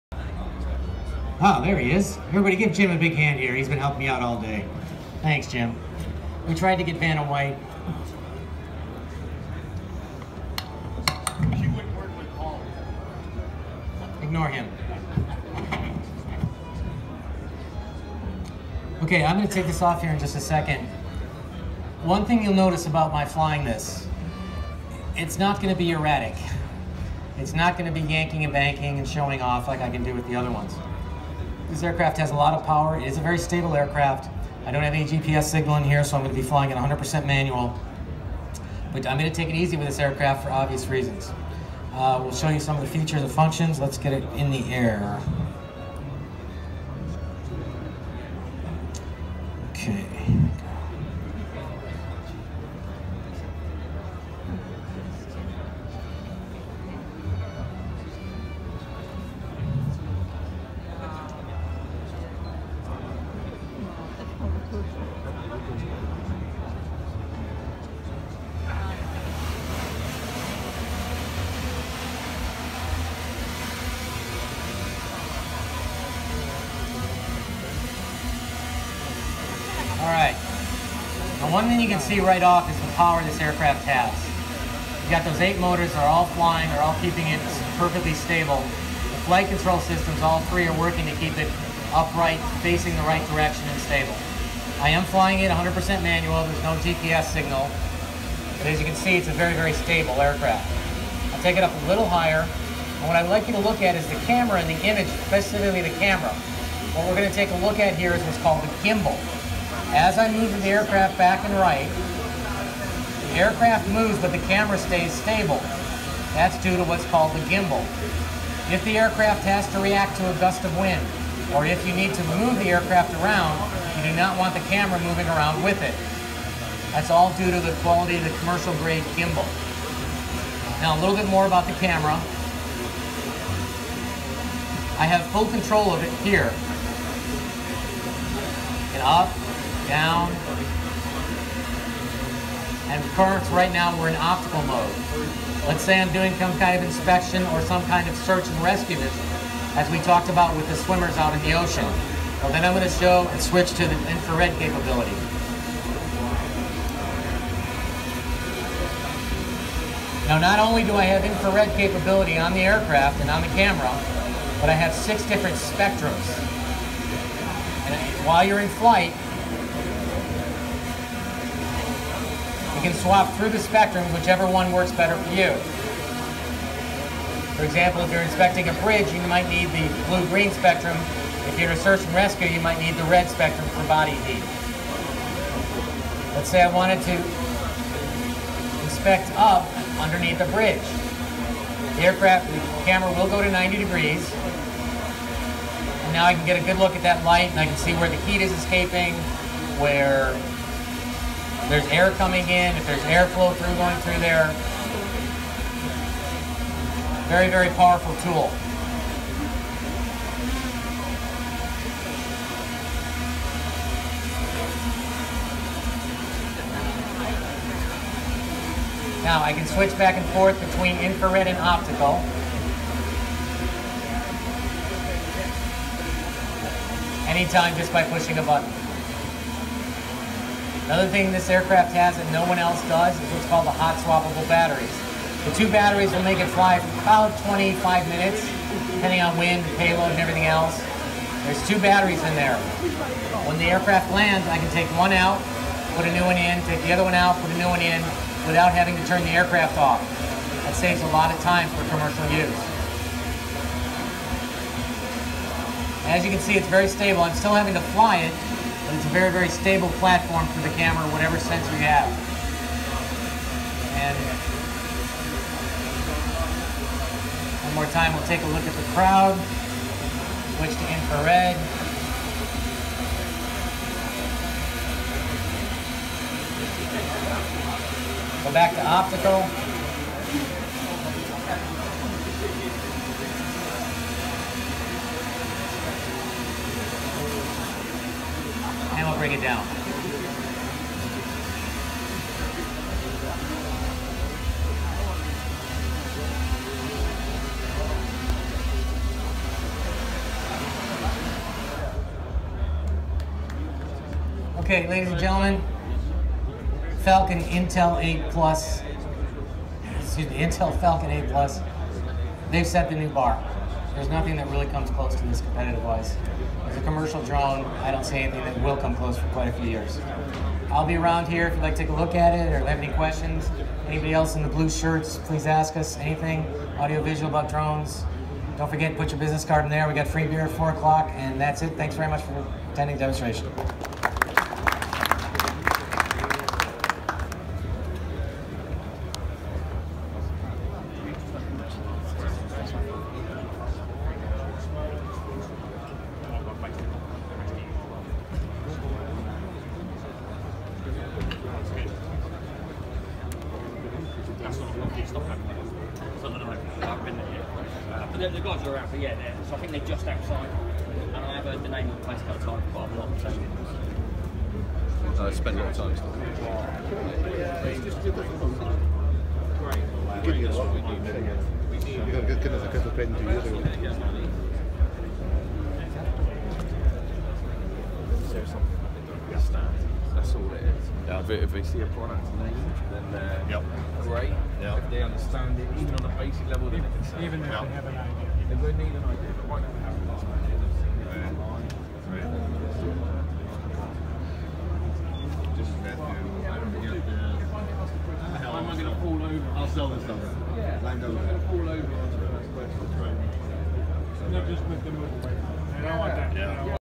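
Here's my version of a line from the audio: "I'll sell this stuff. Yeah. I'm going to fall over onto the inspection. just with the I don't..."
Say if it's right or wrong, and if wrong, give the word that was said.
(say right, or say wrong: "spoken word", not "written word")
wrong: "question", not "inspection".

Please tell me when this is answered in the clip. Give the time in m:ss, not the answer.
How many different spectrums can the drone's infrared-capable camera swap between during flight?
2:44.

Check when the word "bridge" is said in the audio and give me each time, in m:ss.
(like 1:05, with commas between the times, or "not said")
2:58, 3:10.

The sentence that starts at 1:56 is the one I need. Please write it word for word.
That's due to what's called the gimbal.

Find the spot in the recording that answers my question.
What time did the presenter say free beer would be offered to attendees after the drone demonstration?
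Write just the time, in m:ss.
5:30.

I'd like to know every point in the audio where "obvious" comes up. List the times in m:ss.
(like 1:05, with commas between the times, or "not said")
0:40.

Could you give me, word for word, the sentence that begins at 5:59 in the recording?
So I think they're just outside.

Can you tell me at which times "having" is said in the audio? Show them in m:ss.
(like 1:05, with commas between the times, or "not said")
4:08, 4:17.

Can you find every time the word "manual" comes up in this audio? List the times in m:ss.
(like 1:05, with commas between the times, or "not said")
0:37, 1:36.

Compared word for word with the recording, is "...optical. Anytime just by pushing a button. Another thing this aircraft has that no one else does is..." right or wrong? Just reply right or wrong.
right.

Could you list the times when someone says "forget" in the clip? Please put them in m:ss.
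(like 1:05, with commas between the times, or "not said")
5:28.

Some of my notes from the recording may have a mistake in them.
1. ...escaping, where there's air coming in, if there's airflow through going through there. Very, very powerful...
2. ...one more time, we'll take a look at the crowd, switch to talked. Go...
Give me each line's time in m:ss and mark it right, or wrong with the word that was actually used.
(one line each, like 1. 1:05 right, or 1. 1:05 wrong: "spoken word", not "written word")
1. 3:18 right
2. 4:27 wrong: "infrared", not "talked".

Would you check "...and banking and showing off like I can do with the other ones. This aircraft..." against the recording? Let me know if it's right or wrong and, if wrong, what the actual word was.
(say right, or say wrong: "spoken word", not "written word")
right.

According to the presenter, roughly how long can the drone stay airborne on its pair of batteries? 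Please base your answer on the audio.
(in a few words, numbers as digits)
25 minutes.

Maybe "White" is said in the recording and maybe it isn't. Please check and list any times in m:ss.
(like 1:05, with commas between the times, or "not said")
0:07.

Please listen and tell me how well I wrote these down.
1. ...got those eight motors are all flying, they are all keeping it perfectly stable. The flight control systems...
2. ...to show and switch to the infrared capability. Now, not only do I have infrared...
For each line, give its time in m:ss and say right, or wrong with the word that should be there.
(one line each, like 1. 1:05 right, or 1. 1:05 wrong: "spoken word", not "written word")
1. 1:25 right
2. 2:32 right.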